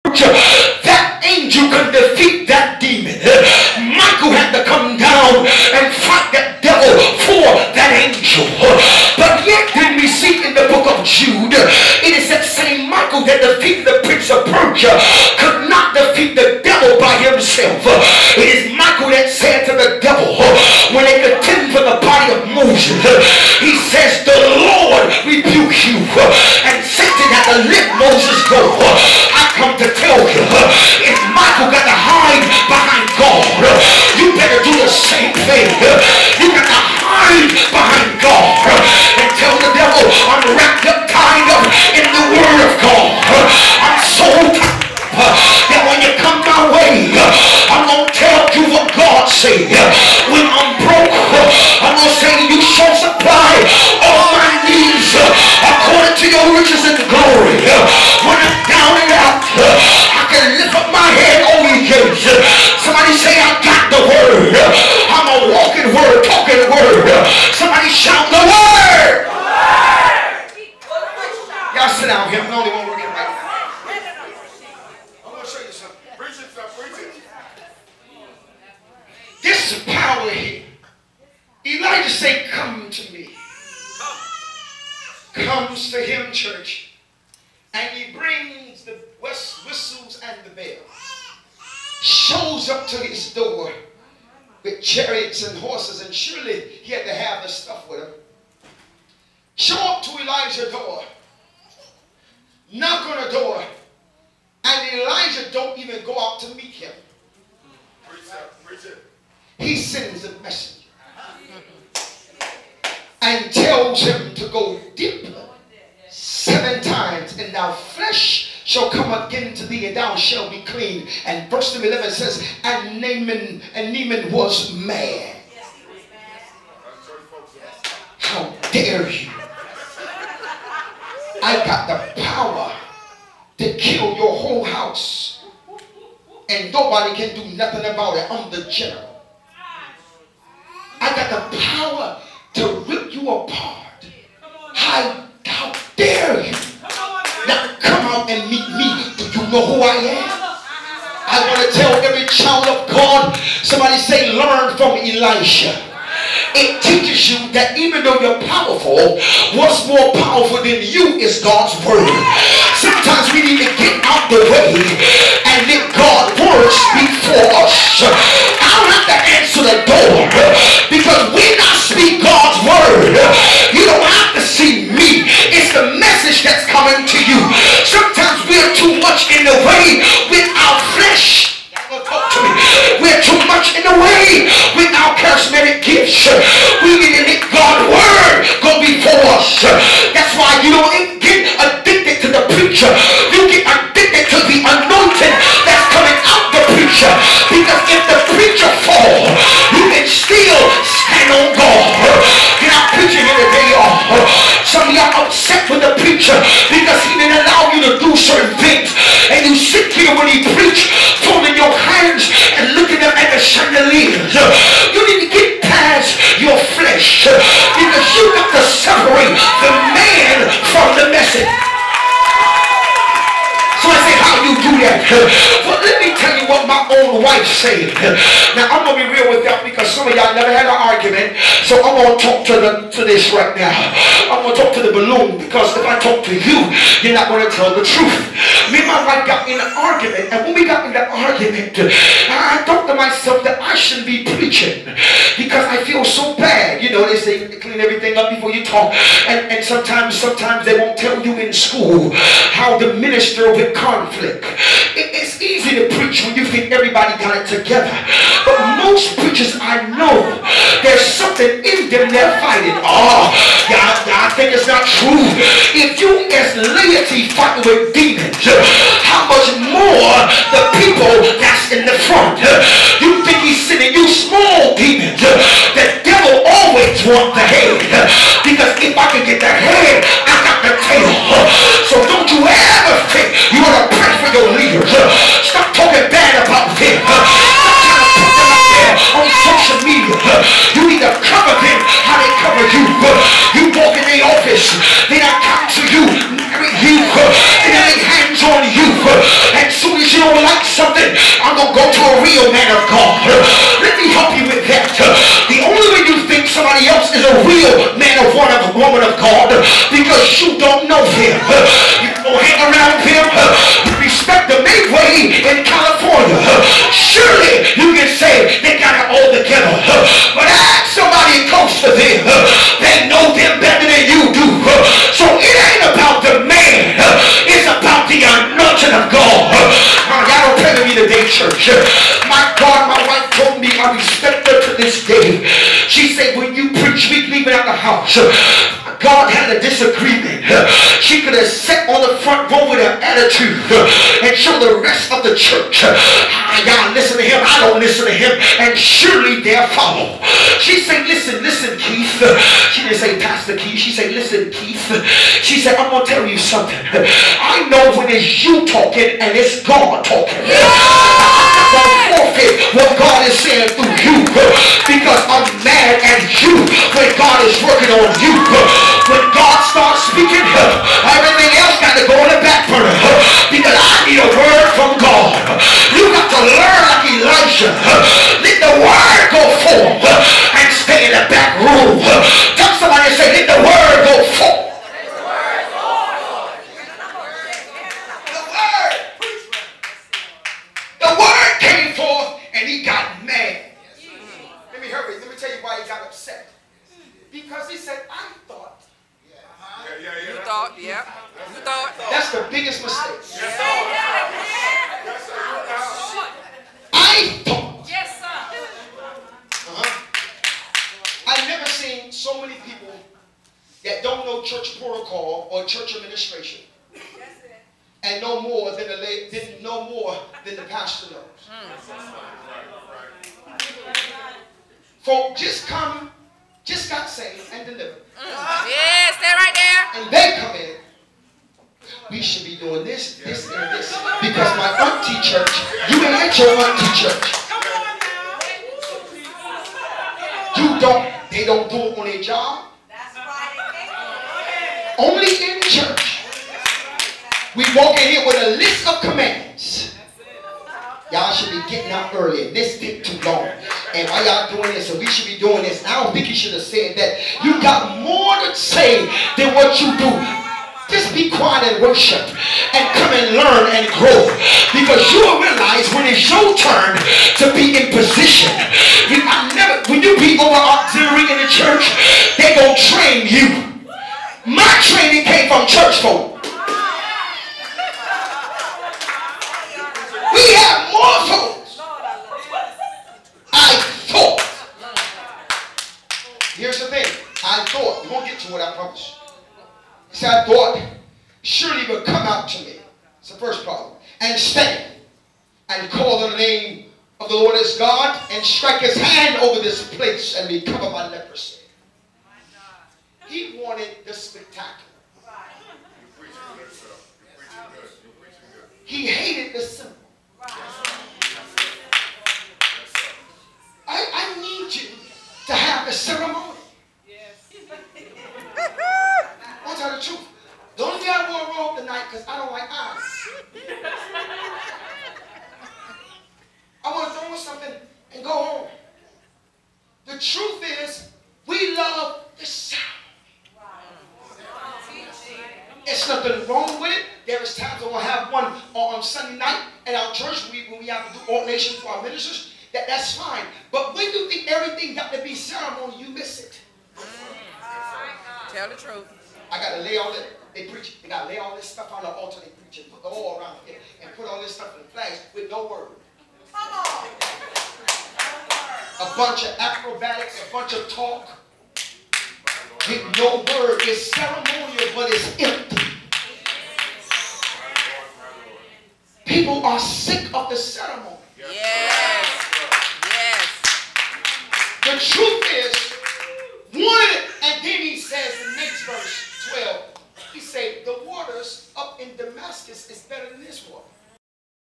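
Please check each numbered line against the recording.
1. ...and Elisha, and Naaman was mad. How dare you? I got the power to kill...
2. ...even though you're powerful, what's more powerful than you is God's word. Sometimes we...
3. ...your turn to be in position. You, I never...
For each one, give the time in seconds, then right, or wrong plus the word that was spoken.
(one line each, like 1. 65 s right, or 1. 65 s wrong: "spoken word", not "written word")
1. 122 s wrong: "Naaman", not "Elisha"
2. 157 s right
3. 466 s right.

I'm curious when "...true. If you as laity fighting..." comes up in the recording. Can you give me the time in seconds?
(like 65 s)
264 s.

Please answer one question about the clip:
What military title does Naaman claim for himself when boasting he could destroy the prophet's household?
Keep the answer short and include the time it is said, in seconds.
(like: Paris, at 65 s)
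general, at 138 s.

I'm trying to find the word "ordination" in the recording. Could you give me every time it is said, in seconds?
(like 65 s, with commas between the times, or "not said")
541 s.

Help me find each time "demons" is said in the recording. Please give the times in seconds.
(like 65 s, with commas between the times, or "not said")
267 s, 274 s.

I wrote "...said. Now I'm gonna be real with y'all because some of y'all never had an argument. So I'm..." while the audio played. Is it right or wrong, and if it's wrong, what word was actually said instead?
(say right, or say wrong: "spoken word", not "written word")
right.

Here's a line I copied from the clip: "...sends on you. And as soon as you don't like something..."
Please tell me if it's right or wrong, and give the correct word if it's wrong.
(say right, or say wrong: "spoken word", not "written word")
wrong: "hands", not "sends".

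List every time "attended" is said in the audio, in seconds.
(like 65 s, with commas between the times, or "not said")
not said.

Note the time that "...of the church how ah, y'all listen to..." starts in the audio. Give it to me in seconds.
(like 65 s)
345 s.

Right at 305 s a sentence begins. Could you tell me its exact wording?
The only way you think somebody else is a real man of one of woman of God because you don't know him.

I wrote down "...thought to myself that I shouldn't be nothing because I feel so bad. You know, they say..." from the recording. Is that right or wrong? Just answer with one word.
wrong.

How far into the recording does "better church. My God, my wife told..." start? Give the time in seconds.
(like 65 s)
330 s.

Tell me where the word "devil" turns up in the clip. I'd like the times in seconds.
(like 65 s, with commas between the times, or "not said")
19 s, 276 s.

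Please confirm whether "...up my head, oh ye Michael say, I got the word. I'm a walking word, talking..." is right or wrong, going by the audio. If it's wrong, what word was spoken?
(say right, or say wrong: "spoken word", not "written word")
wrong: "Somebody", not "Michael".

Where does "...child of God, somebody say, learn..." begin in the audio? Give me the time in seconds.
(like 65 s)
152 s.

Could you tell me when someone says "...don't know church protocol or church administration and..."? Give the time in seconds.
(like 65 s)
414 s.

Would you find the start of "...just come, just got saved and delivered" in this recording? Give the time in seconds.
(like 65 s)
425 s.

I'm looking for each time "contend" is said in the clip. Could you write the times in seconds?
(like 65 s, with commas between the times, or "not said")
21 s.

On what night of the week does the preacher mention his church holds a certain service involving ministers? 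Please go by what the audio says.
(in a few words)
Sunday night.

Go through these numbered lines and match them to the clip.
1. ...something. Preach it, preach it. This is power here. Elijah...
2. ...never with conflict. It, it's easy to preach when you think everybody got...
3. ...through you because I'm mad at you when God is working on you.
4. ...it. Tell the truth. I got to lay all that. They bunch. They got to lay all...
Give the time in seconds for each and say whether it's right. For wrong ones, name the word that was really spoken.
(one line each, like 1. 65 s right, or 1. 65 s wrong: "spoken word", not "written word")
1. 75 s right
2. 252 s wrong: "minister", not "never"
3. 363 s right
4. 546 s wrong: "preach", not "bunch".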